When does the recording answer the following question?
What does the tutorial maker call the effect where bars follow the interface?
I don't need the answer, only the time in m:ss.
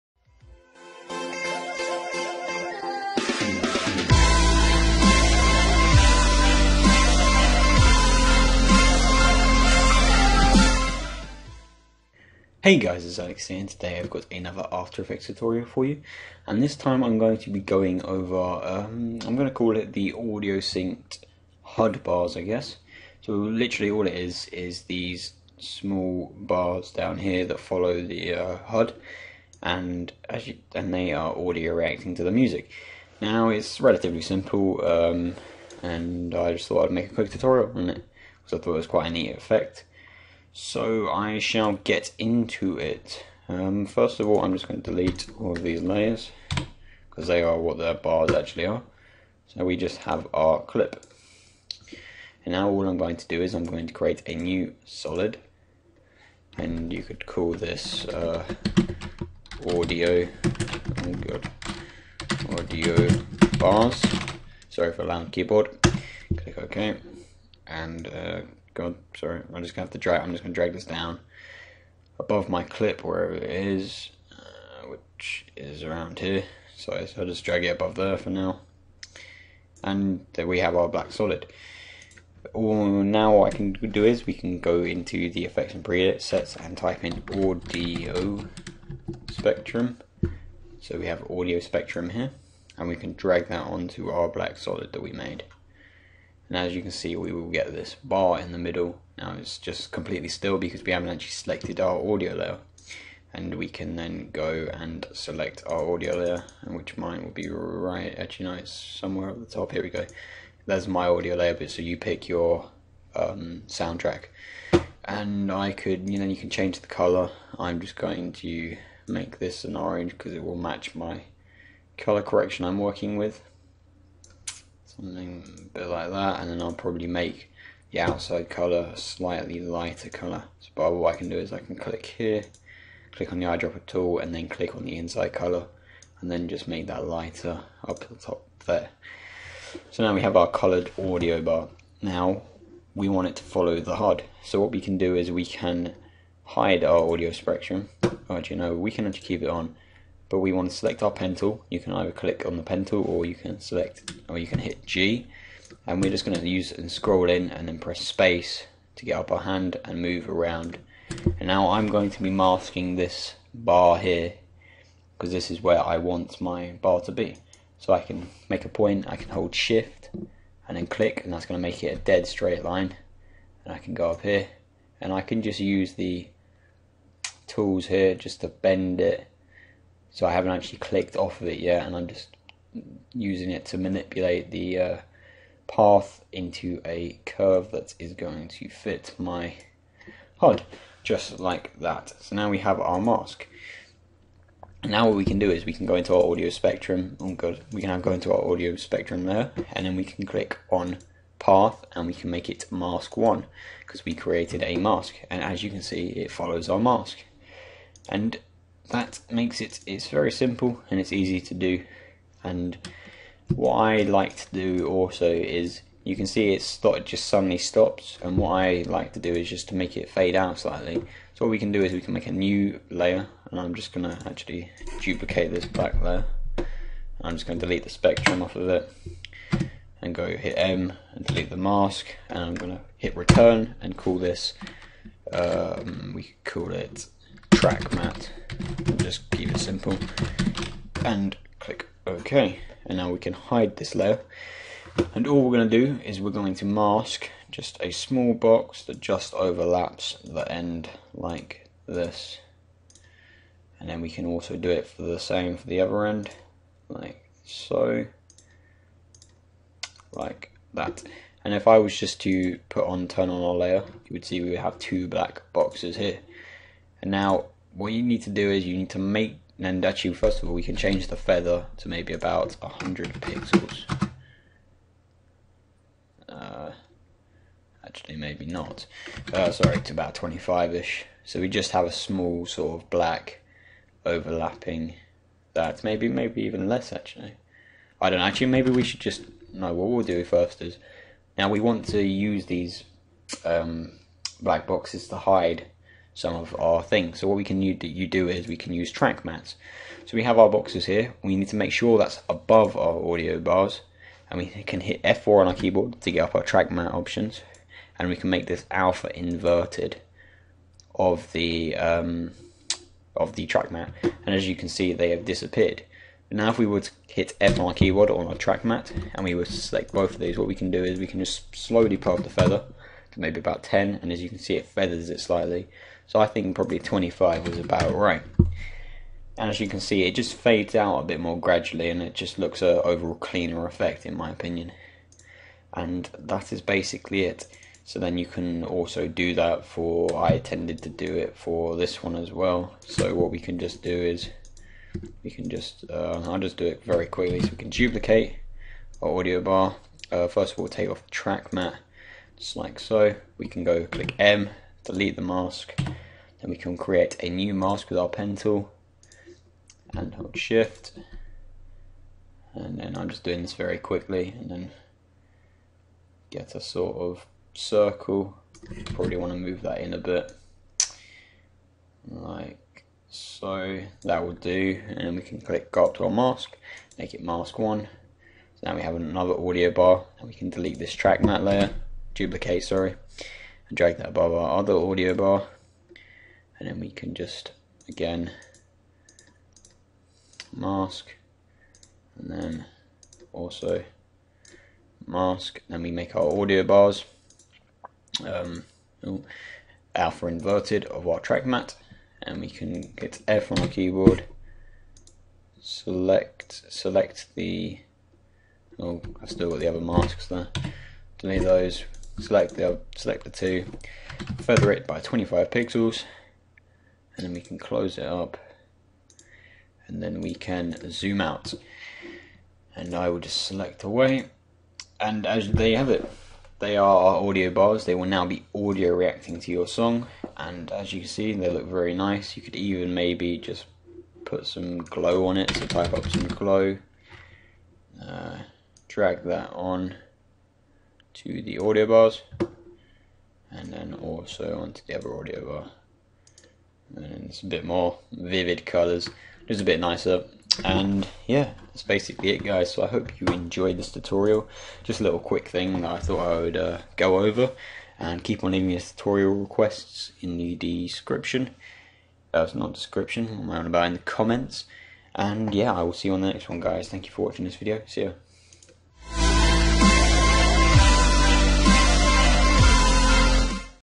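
0:20.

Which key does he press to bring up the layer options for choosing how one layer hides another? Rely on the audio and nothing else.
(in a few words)
F4.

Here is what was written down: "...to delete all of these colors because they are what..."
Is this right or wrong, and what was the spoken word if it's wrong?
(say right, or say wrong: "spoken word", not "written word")
wrong: "layers", not "colors".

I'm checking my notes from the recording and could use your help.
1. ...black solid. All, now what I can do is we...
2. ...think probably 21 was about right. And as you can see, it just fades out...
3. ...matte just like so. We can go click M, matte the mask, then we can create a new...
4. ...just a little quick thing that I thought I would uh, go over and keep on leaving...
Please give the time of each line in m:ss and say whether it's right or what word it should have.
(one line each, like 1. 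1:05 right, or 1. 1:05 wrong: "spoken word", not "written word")
1. 1:20 right
2. 5:26 wrong: "25", not "21"
3. 5:51 wrong: "delete", not "matte"
4. 7:34 right.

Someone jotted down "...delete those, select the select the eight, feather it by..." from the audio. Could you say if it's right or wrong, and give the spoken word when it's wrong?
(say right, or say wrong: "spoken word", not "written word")
wrong: "two", not "eight".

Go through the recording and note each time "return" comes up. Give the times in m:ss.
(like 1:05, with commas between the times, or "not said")
3:53.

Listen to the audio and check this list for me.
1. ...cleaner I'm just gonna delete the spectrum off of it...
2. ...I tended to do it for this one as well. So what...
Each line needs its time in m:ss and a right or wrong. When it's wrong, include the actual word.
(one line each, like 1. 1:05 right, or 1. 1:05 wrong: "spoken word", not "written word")
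1. 3:46 wrong: "layer", not "cleaner"
2. 5:40 right.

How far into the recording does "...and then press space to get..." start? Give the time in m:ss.
2:37.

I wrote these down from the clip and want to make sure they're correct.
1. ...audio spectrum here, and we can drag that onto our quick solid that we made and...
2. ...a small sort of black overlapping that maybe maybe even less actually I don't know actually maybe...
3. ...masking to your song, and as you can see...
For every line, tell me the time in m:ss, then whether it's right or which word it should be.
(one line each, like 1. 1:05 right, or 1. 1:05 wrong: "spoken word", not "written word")
1. 1:31 wrong: "black", not "quick"
2. 4:41 right
3. 7:08 wrong: "reacting", not "masking".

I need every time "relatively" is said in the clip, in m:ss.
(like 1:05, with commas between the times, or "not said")
0:33.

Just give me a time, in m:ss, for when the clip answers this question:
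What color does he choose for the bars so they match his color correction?
1:59.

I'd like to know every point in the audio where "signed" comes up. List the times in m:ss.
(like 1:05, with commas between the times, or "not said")
not said.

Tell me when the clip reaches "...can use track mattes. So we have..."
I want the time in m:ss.
4:58.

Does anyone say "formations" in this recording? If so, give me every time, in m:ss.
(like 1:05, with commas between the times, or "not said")
not said.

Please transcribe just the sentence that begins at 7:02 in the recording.
And I will just select away, and as there you have it.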